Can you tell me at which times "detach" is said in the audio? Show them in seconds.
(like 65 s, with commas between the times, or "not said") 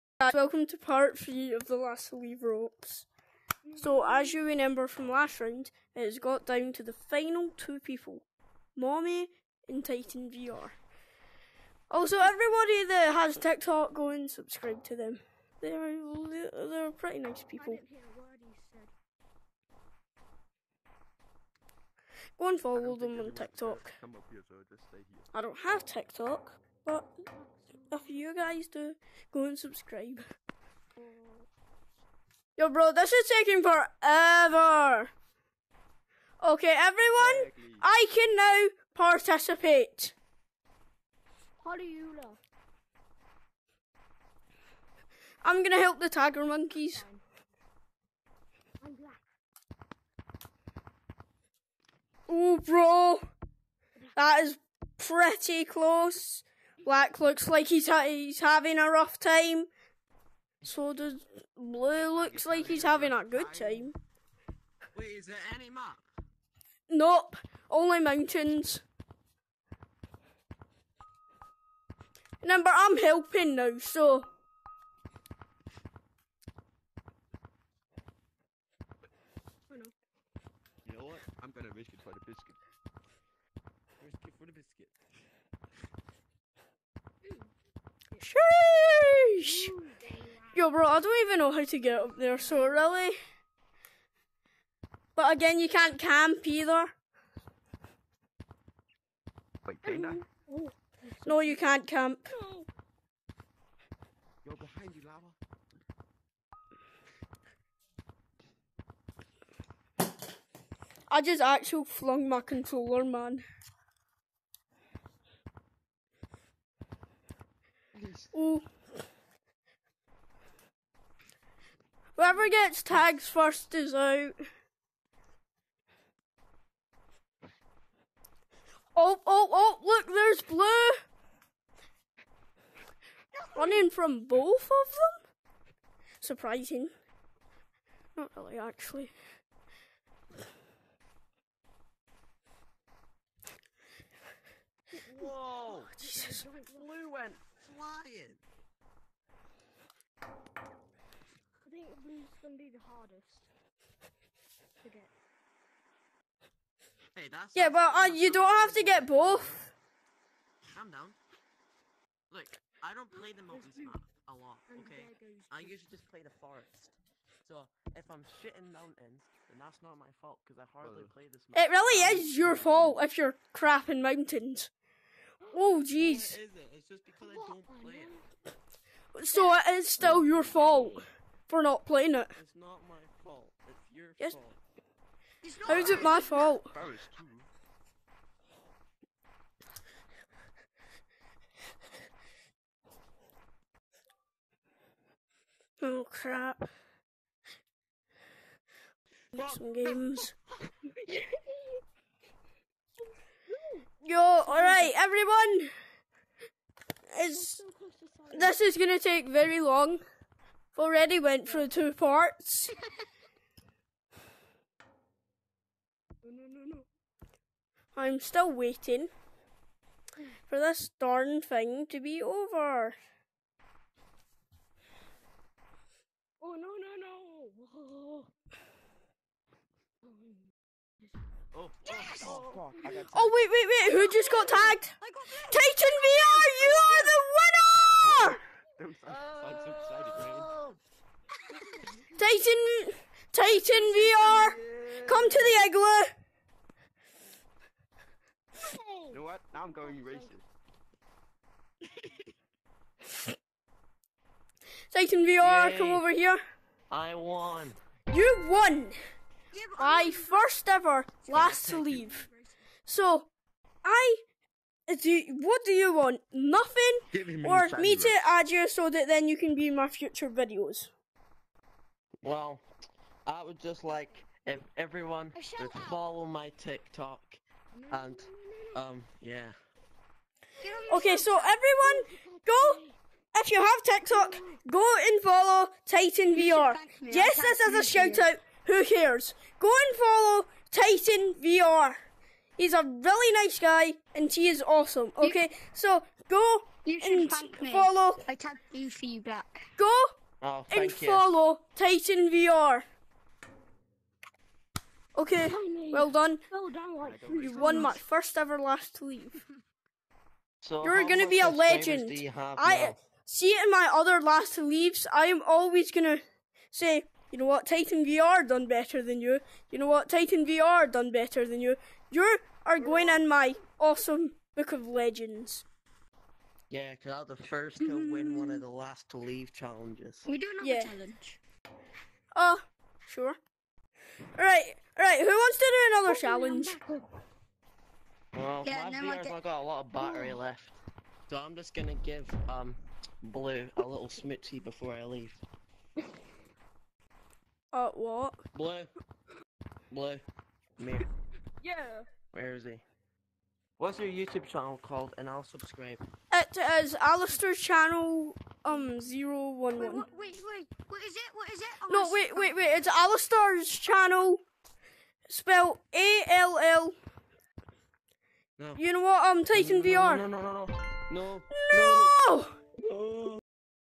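not said.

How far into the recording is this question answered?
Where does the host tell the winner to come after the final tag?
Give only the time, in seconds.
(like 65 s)
245 s.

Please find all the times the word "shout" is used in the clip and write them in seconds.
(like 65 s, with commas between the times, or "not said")
287 s.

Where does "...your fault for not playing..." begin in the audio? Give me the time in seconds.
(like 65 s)
180 s.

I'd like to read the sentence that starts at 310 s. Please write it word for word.
So You're gonna be a legend.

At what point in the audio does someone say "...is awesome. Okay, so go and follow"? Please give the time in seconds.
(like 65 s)
294 s.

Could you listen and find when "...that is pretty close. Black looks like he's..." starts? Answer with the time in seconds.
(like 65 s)
54 s.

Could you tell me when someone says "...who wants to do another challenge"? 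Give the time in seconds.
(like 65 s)
335 s.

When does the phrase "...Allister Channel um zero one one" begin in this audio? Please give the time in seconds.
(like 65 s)
357 s.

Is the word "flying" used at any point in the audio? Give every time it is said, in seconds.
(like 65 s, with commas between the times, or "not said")
147 s.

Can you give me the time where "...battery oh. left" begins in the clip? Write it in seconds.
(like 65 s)
339 s.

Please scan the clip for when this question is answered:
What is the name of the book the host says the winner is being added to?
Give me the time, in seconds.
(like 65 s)
323 s.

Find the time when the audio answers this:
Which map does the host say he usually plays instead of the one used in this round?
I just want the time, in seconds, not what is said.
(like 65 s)
166 s.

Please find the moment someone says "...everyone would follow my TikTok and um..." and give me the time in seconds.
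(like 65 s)
274 s.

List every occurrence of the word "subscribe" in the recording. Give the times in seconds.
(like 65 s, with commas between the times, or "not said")
14 s, 29 s, 355 s.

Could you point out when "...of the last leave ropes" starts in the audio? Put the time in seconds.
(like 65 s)
1 s.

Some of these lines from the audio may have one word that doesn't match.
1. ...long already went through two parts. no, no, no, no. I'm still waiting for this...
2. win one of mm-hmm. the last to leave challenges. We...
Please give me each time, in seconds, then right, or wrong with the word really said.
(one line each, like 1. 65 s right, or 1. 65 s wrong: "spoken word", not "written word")
1. 209 s right
2. 328 s right.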